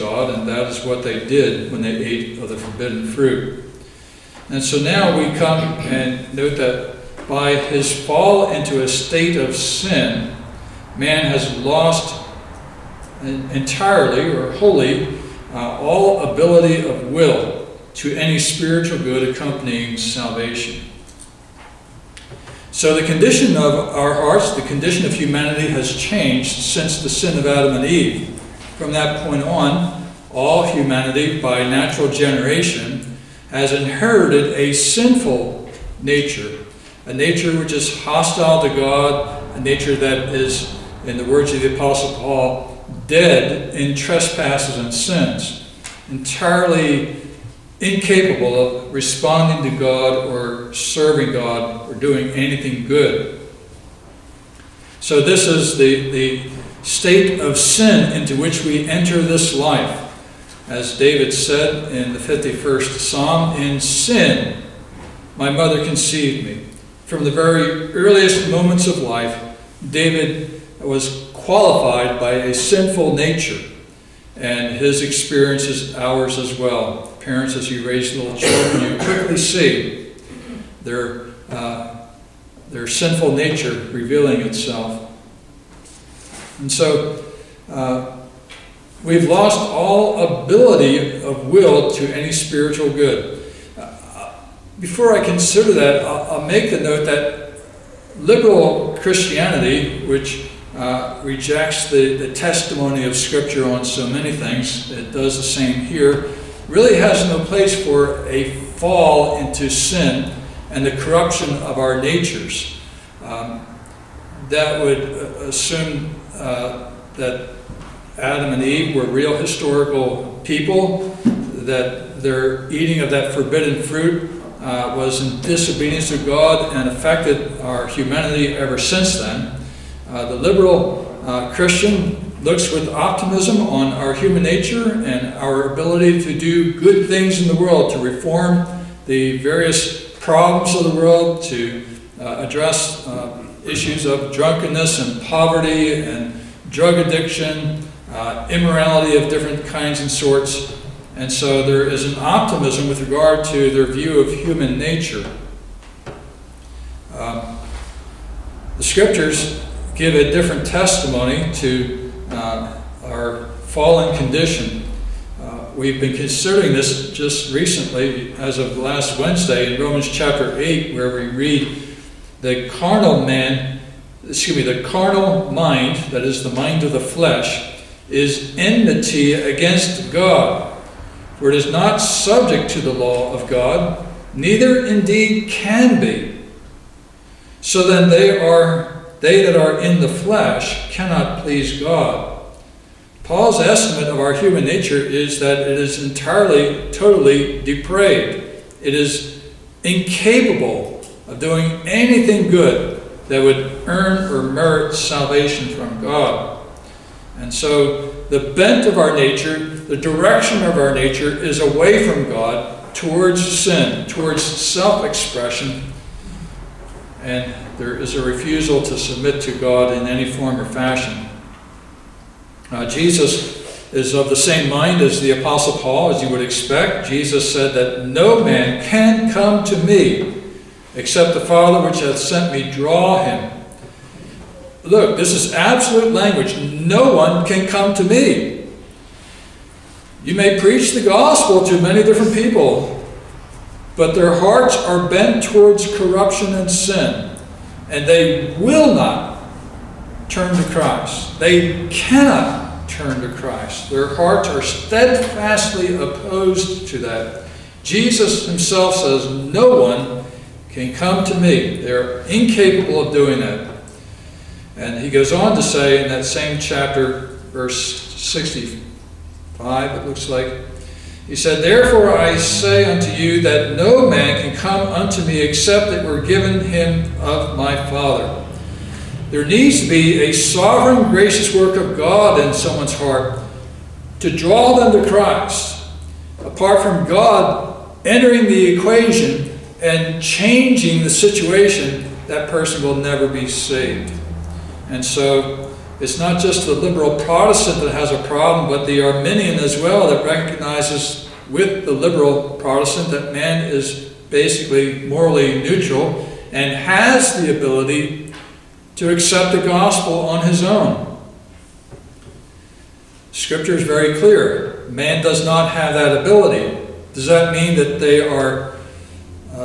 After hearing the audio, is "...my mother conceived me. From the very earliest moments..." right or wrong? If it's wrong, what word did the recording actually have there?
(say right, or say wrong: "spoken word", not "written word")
right.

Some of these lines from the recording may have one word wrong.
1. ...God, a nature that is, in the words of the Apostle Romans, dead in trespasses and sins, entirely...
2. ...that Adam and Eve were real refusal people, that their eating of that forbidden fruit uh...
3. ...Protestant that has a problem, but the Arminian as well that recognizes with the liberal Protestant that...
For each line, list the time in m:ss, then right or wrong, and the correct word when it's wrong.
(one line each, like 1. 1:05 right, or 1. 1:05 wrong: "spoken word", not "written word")
1. 0:38 wrong: "Paul", not "Romans"
2. 1:57 wrong: "historical", not "refusal"
3. 4:57 right.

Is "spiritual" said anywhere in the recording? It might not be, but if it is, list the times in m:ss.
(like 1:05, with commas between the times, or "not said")
0:18, 1:32.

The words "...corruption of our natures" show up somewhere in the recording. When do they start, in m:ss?
1:50.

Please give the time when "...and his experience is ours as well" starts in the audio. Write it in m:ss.
1:14.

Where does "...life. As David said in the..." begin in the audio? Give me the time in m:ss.
0:59.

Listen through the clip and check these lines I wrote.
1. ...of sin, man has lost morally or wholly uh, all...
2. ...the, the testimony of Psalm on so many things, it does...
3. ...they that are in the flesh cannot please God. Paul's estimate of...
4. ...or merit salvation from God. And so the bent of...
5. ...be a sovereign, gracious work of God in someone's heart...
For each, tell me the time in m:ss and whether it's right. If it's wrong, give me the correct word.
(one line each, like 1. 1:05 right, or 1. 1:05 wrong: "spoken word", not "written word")
1. 0:09 wrong: "entirely", not "morally"
2. 1:41 wrong: "Scripture", not "Psalm"
3. 3:09 right
4. 3:24 right
5. 4:39 right.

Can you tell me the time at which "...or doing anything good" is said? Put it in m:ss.
0:51.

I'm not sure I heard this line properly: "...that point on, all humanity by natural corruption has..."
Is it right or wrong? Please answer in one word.
wrong.